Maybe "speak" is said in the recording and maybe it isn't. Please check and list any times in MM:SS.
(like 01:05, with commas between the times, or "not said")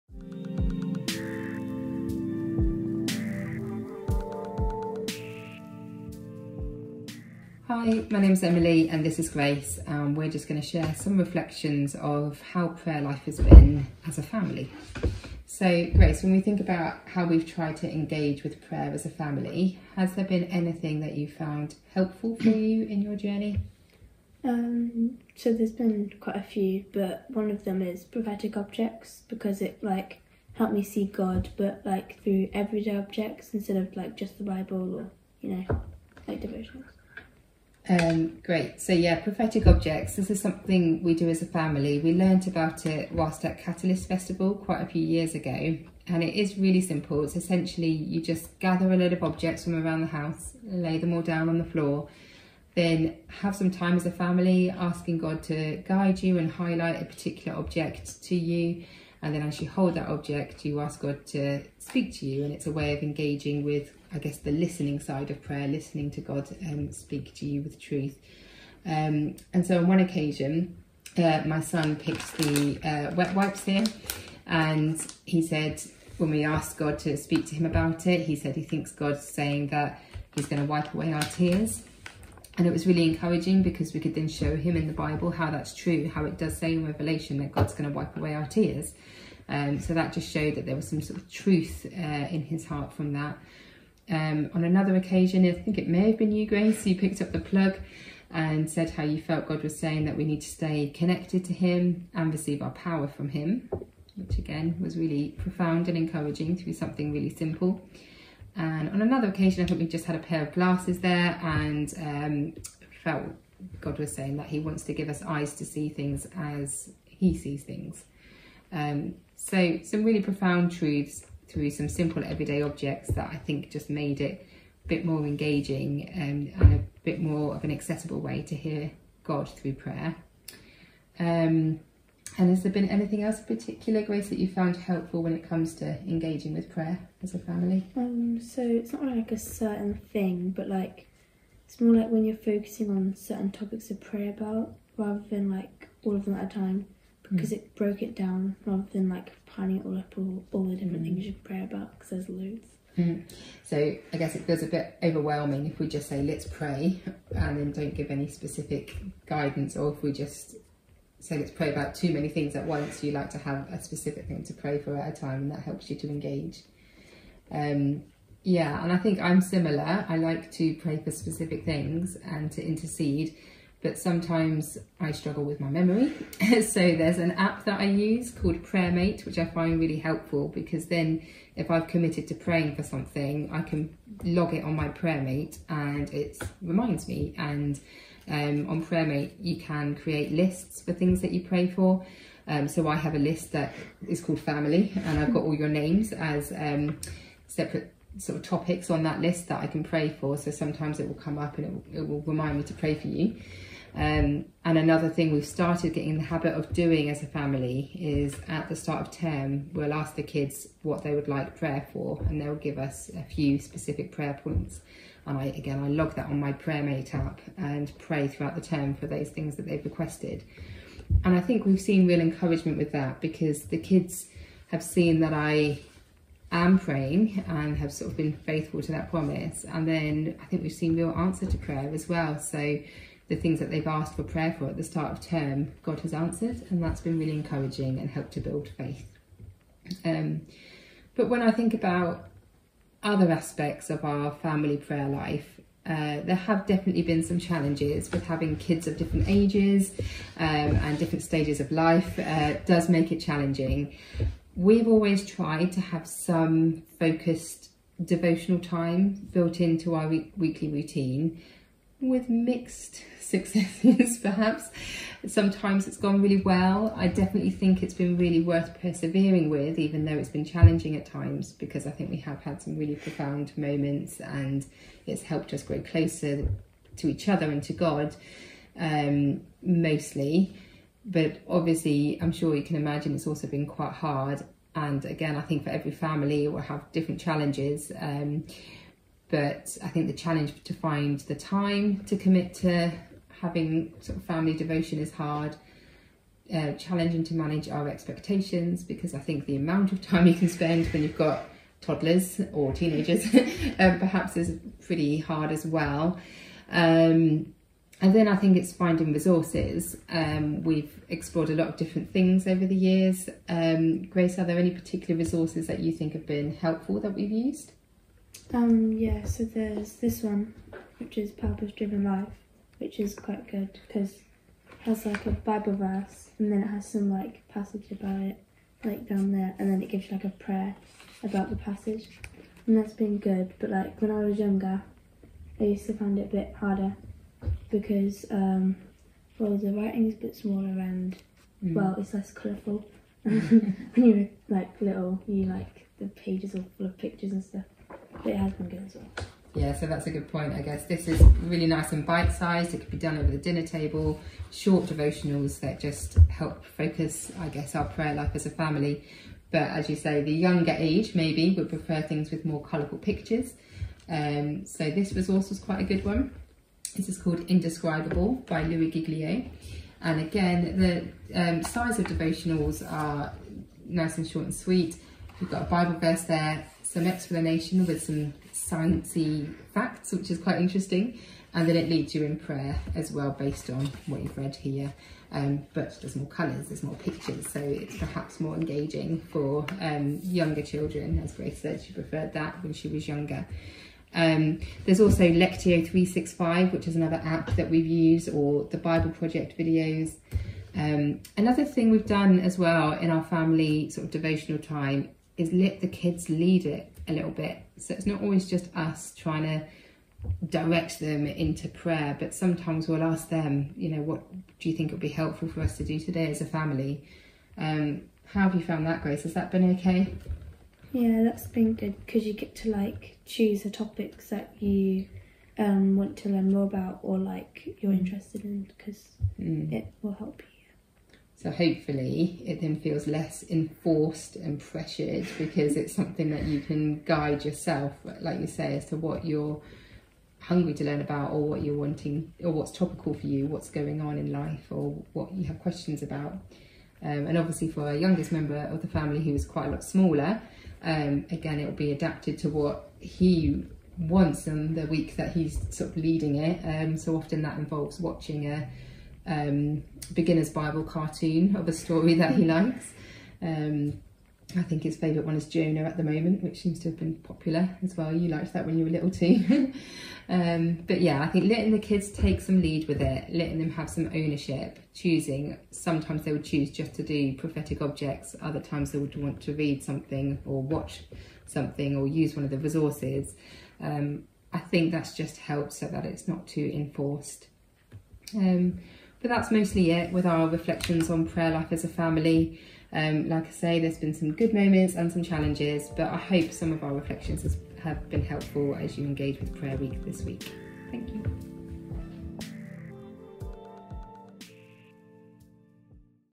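01:01, 01:06, 01:17.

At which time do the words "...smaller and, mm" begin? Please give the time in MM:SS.
05:40.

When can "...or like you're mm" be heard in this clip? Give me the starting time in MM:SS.
07:07.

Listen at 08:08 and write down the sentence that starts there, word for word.
Um, but that's mostly it with our reflections on prayer life as a family.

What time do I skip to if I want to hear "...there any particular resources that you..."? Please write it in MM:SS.
05:14.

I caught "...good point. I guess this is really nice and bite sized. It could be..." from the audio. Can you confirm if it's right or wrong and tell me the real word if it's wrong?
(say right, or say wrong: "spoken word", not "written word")
right.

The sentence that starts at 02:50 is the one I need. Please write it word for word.
I like to pray for specific things and to intercede, but sometimes I struggle with my memory.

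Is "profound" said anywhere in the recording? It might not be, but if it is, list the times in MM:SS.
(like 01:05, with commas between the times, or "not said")
01:45, 02:00, 04:32.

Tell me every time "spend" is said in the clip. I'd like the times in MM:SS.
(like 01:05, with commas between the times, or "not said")
05:00.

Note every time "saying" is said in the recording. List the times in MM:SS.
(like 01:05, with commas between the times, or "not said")
01:19, 01:39, 01:54.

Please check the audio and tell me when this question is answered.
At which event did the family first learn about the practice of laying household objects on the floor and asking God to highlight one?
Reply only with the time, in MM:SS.
00:43.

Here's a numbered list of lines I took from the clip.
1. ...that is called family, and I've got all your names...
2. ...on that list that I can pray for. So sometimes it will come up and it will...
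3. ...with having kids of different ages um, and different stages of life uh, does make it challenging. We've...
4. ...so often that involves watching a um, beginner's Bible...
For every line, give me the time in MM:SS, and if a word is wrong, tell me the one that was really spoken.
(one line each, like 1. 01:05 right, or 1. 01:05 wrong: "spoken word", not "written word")
1. 03:13 right
2. 03:18 right
3. 04:08 right
4. 07:36 right.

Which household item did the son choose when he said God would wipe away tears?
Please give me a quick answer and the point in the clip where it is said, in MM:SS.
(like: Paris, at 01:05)
wet wipes, at 01:13.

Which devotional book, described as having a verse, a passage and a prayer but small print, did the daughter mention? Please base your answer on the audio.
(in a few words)
Purpose Driven Life.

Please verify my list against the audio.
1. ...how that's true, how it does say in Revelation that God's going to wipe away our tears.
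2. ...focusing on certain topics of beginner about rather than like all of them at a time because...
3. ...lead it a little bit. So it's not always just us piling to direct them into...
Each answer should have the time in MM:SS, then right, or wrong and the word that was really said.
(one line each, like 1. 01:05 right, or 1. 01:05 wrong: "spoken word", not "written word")
1. 01:25 right
2. 02:22 wrong: "prayer", not "beginner"
3. 06:46 wrong: "trying", not "piling".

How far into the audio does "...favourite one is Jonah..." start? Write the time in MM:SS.
07:44.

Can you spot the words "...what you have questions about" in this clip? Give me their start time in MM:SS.
07:25.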